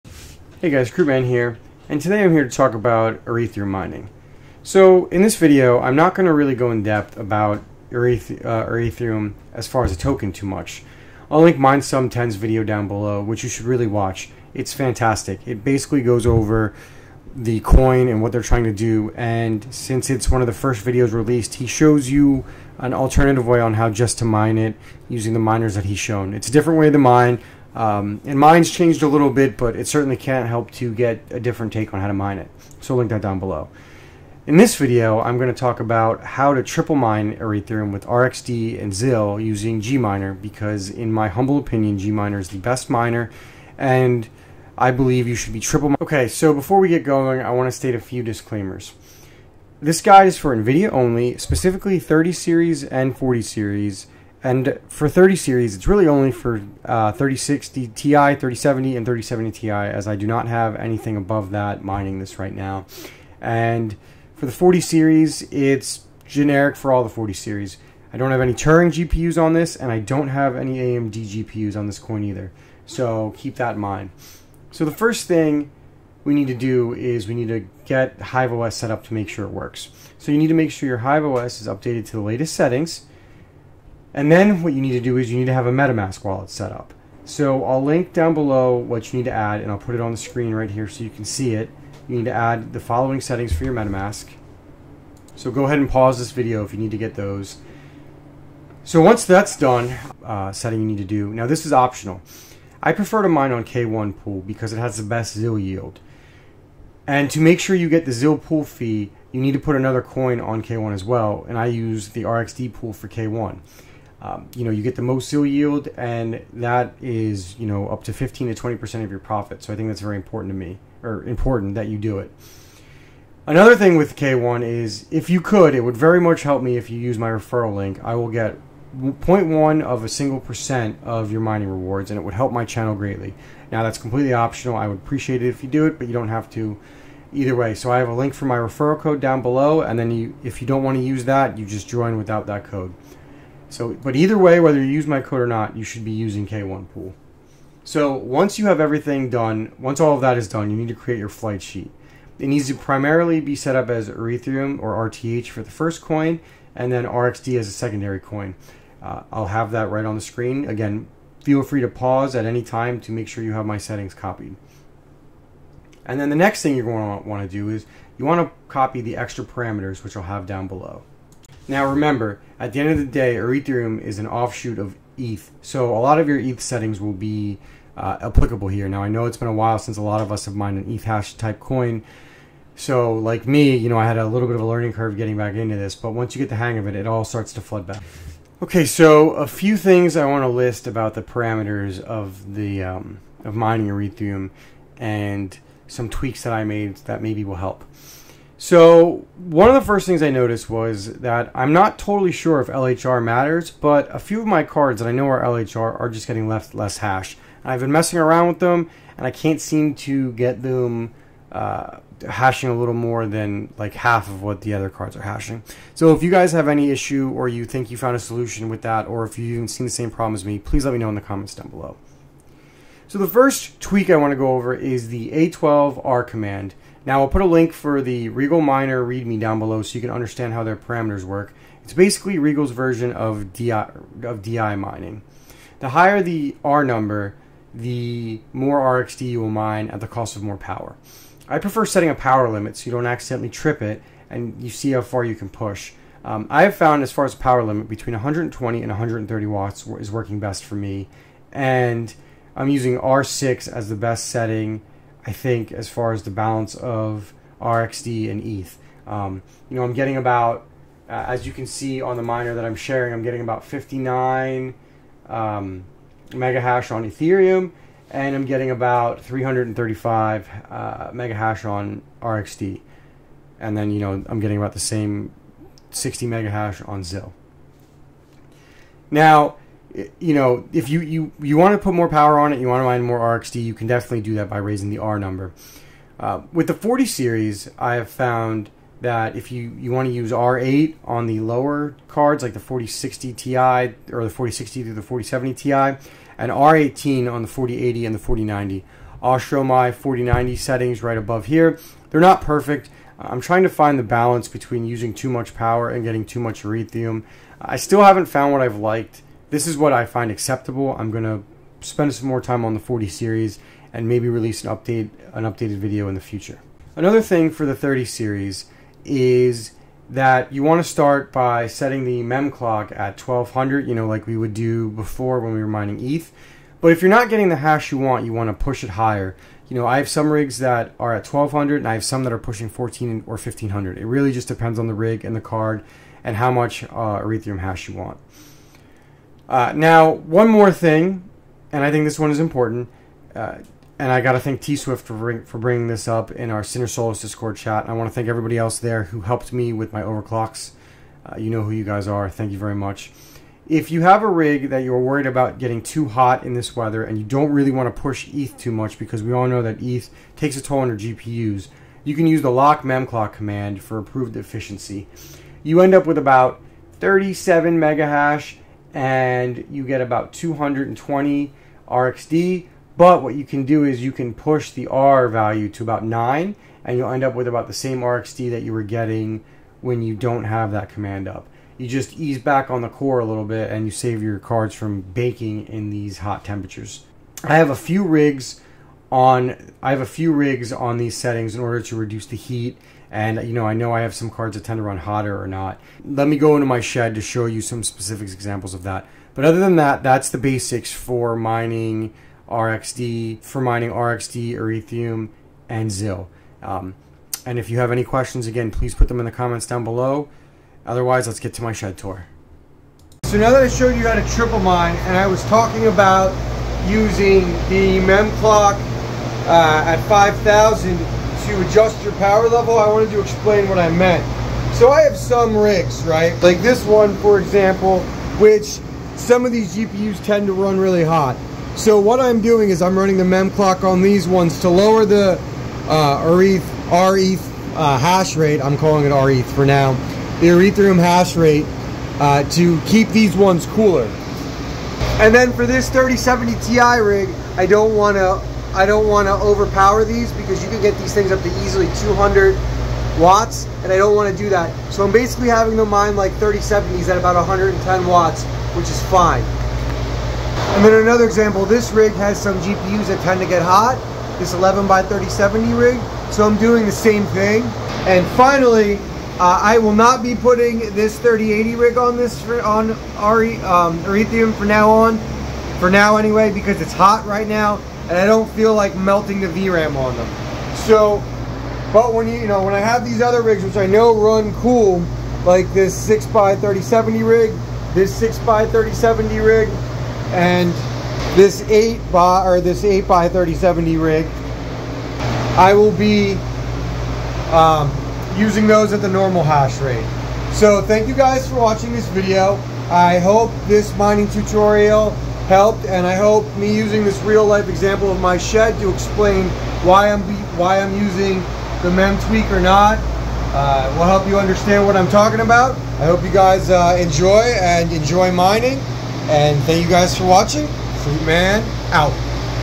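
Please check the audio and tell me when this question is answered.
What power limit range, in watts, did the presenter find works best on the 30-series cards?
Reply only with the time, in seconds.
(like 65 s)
247 s.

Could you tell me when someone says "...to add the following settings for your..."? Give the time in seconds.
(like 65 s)
92 s.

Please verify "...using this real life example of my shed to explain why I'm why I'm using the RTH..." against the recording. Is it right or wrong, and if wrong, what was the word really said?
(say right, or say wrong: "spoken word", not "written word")
wrong: "Mem", not "RTH".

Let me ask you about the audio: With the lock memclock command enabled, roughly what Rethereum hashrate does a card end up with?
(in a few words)
37 megahash.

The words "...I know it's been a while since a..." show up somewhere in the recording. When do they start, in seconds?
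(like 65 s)
179 s.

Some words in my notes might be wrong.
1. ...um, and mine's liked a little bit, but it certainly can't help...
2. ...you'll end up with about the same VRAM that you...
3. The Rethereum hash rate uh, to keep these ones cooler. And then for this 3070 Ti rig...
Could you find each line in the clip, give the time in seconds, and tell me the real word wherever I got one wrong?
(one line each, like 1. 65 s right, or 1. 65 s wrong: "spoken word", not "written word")
1. 27 s wrong: "changed", not "liked"
2. 376 s wrong: "RxD", not "VRAM"
3. 440 s right.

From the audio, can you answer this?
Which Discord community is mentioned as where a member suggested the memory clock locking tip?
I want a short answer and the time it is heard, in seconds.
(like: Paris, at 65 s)
Sinner Solos, at 346 s.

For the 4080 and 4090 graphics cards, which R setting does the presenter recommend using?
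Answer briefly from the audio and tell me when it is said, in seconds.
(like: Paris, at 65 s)
R18, at 296 s.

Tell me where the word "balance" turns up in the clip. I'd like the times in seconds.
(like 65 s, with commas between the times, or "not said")
256 s, 304 s.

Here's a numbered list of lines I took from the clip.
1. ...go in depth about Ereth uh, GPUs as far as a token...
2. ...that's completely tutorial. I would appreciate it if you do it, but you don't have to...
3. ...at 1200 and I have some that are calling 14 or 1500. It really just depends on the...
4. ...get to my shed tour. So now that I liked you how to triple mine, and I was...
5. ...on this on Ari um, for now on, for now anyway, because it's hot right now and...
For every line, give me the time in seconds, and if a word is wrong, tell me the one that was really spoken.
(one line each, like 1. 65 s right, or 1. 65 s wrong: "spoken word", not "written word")
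1. 6 s wrong: "Rethereum", not "GPUs"
2. 133 s wrong: "optional", not "tutorial"
3. 331 s wrong: "pushing", not "calling"
4. 411 s wrong: "showed", not "liked"
5. 471 s right.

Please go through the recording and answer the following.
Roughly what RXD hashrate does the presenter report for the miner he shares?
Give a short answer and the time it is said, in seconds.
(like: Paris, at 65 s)
335 megahash, at 269 s.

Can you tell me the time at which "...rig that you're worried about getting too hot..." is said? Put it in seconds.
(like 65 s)
354 s.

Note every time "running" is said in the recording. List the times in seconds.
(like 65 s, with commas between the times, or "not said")
432 s.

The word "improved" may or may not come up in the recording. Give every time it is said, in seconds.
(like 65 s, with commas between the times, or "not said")
363 s.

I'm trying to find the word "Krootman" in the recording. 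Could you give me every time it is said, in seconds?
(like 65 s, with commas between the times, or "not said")
0 s, 521 s.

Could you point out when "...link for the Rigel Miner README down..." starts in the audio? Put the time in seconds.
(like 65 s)
227 s.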